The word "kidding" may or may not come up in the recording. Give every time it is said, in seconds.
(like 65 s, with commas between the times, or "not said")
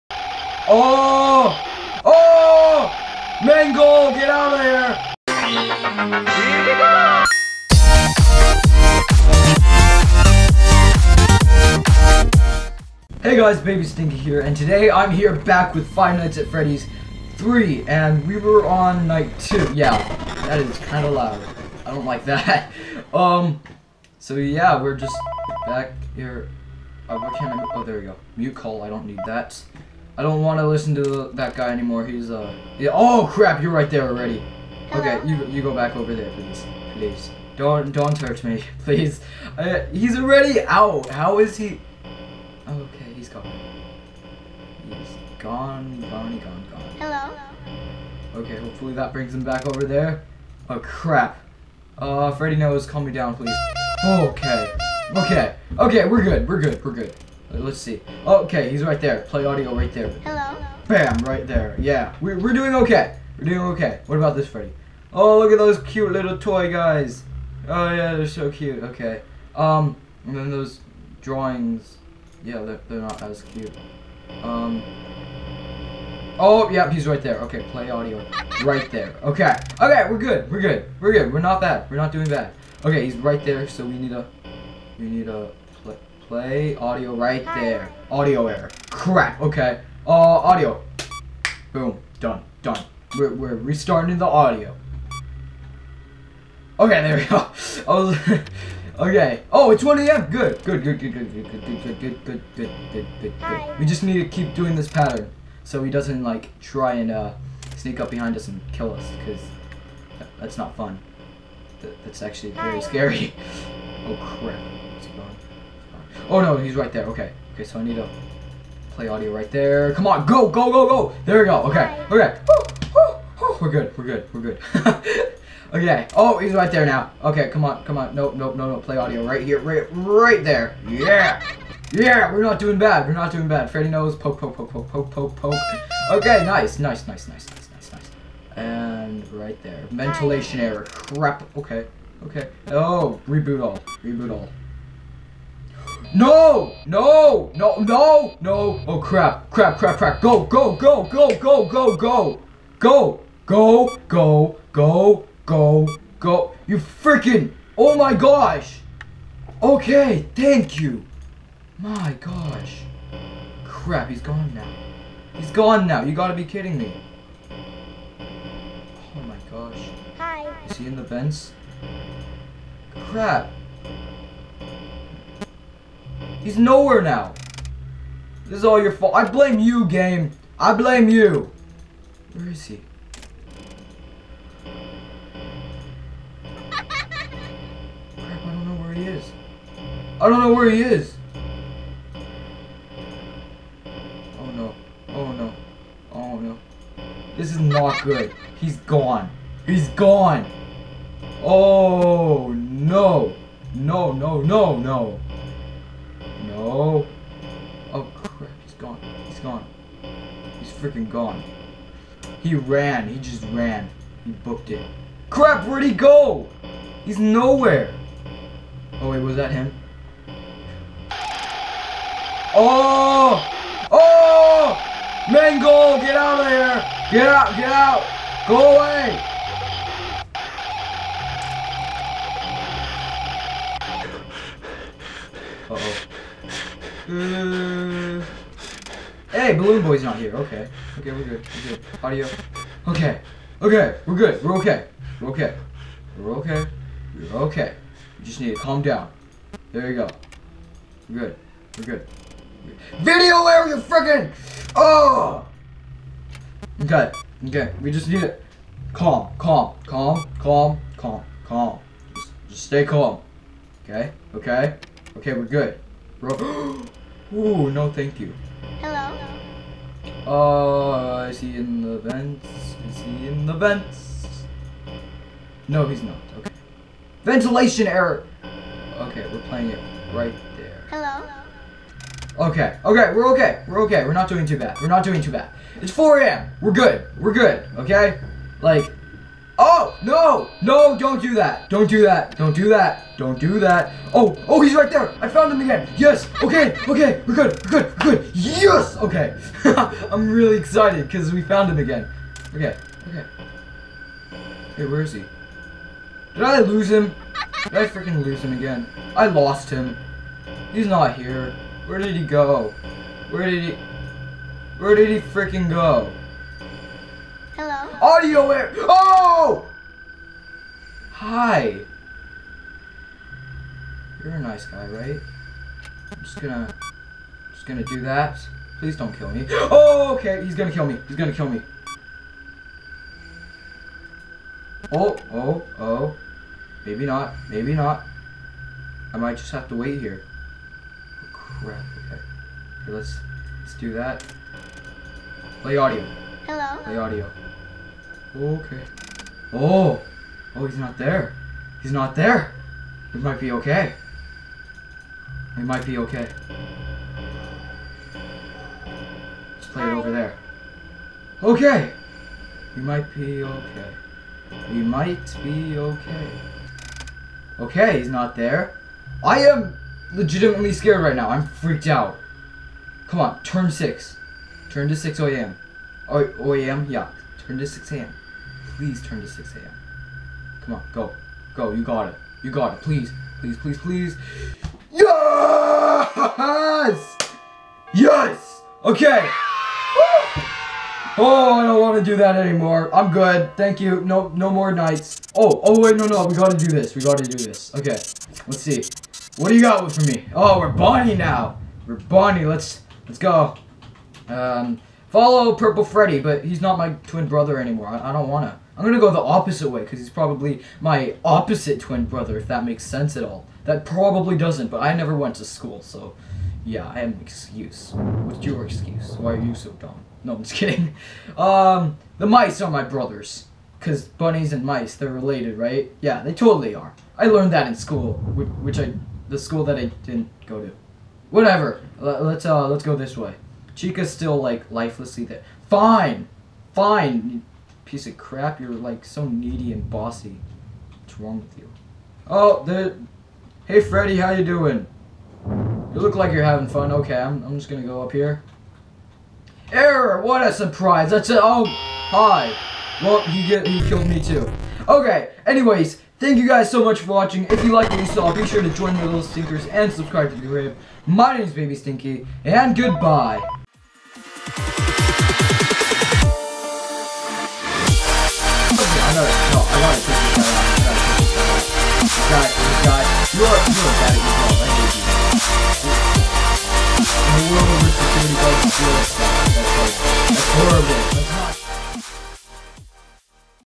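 166 s, 420 s.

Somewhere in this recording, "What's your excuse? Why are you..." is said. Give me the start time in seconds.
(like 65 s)
417 s.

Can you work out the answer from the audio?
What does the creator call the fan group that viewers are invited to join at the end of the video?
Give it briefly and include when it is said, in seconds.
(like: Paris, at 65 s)
the little stinkers, at 458 s.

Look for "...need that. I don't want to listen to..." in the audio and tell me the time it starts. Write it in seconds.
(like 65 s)
29 s.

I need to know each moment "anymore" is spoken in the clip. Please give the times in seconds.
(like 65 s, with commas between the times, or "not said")
31 s, 392 s, 407 s.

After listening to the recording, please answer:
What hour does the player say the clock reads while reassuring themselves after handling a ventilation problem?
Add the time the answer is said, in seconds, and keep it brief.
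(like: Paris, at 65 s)
4 a.m., at 285 s.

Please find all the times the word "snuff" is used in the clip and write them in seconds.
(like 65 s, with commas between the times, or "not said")
not said.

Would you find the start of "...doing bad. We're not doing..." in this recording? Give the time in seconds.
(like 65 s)
132 s.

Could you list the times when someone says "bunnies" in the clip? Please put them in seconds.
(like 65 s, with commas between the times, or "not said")
424 s.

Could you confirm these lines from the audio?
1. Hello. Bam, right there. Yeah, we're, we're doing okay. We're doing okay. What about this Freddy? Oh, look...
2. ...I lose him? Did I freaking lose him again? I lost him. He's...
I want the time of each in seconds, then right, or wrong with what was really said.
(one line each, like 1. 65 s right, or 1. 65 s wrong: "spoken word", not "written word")
1. 60 s right
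2. 306 s right.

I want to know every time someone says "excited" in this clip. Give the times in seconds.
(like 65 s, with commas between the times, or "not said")
300 s.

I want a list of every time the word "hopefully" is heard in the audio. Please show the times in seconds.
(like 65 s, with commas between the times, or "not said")
48 s.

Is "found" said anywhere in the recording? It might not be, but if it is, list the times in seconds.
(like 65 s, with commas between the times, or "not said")
295 s, 301 s.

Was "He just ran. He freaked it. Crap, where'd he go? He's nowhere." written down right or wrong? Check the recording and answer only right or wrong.
wrong.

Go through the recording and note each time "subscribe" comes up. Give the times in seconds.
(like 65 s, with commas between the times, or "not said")
459 s.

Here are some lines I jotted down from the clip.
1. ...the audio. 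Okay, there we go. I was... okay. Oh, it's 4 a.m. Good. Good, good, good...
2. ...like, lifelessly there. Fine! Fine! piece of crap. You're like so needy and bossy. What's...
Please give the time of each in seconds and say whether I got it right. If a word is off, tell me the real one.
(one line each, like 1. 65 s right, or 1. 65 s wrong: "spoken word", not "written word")
1. 94 s wrong: "1", not "4"
2. 434 s right.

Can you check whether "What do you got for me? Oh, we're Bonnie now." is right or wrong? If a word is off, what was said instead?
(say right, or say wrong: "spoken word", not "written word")
right.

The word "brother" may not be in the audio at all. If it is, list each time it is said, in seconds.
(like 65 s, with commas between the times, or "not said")
407 s, 412 s, 422 s.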